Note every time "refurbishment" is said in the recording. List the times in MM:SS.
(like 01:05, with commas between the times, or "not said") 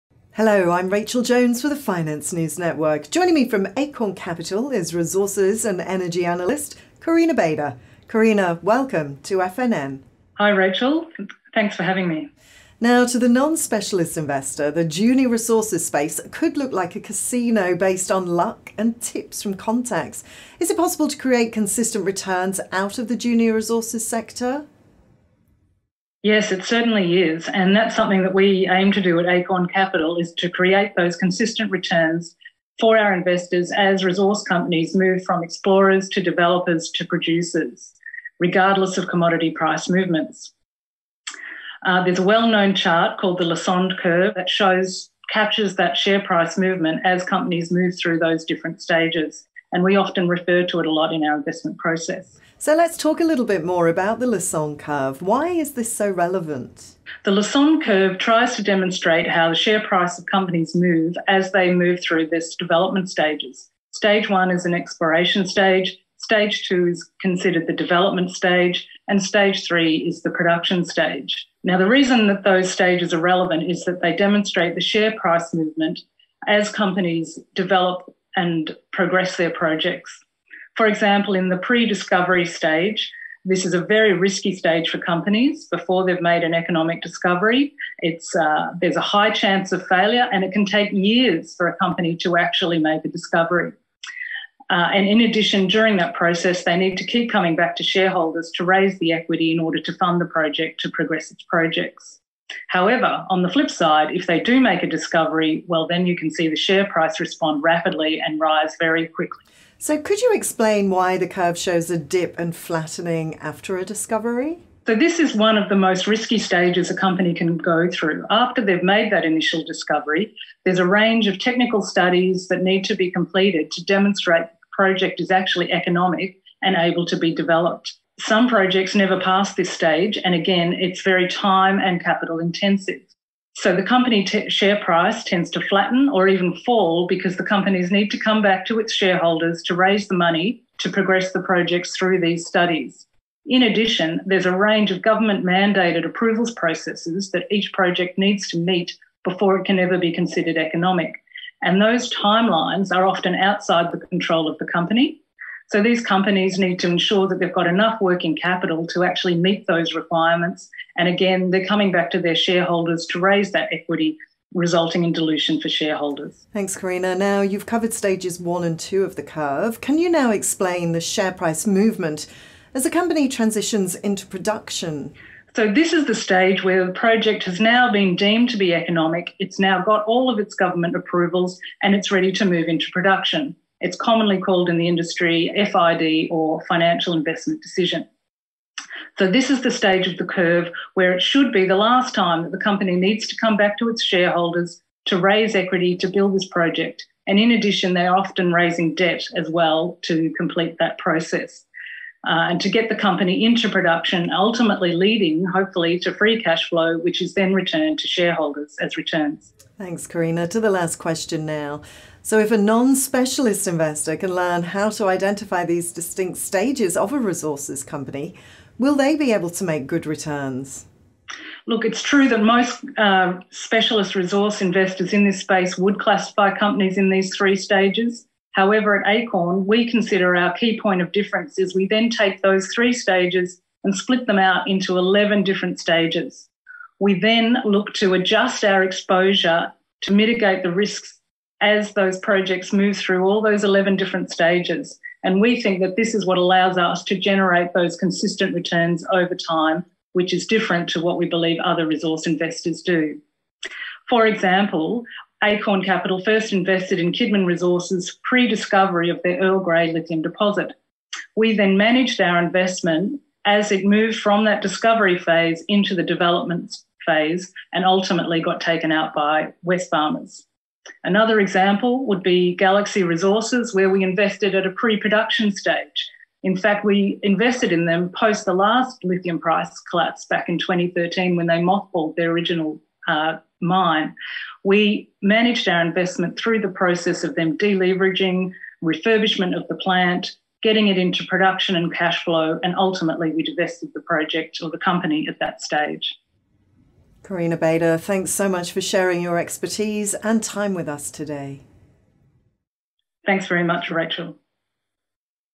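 04:48.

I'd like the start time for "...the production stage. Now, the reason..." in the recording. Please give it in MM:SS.
01:10.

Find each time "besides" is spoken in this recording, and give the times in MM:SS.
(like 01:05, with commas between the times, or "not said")
not said.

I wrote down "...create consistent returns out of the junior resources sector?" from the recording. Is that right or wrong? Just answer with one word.
right.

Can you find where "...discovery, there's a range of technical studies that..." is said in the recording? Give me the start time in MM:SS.
01:59.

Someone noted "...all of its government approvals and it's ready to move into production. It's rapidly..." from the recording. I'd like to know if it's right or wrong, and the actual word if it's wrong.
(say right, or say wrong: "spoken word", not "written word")
wrong: "commonly", not "rapidly".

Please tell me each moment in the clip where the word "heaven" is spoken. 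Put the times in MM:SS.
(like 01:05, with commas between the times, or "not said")
not said.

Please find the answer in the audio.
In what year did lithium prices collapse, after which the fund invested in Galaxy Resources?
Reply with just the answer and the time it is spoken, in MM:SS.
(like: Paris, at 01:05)
2013, at 04:40.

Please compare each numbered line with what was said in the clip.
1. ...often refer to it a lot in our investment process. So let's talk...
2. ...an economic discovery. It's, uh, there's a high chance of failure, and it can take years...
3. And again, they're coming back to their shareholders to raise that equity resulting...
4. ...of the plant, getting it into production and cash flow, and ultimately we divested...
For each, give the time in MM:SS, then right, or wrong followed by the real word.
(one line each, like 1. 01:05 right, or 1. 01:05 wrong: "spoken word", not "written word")
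1. 00:49 right
2. 01:26 right
3. 02:40 right
4. 04:49 right.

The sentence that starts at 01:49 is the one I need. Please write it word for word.
So, could you explain why the curve shows a dip and flattening after a discovery?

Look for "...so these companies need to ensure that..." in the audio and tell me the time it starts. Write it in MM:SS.
02:35.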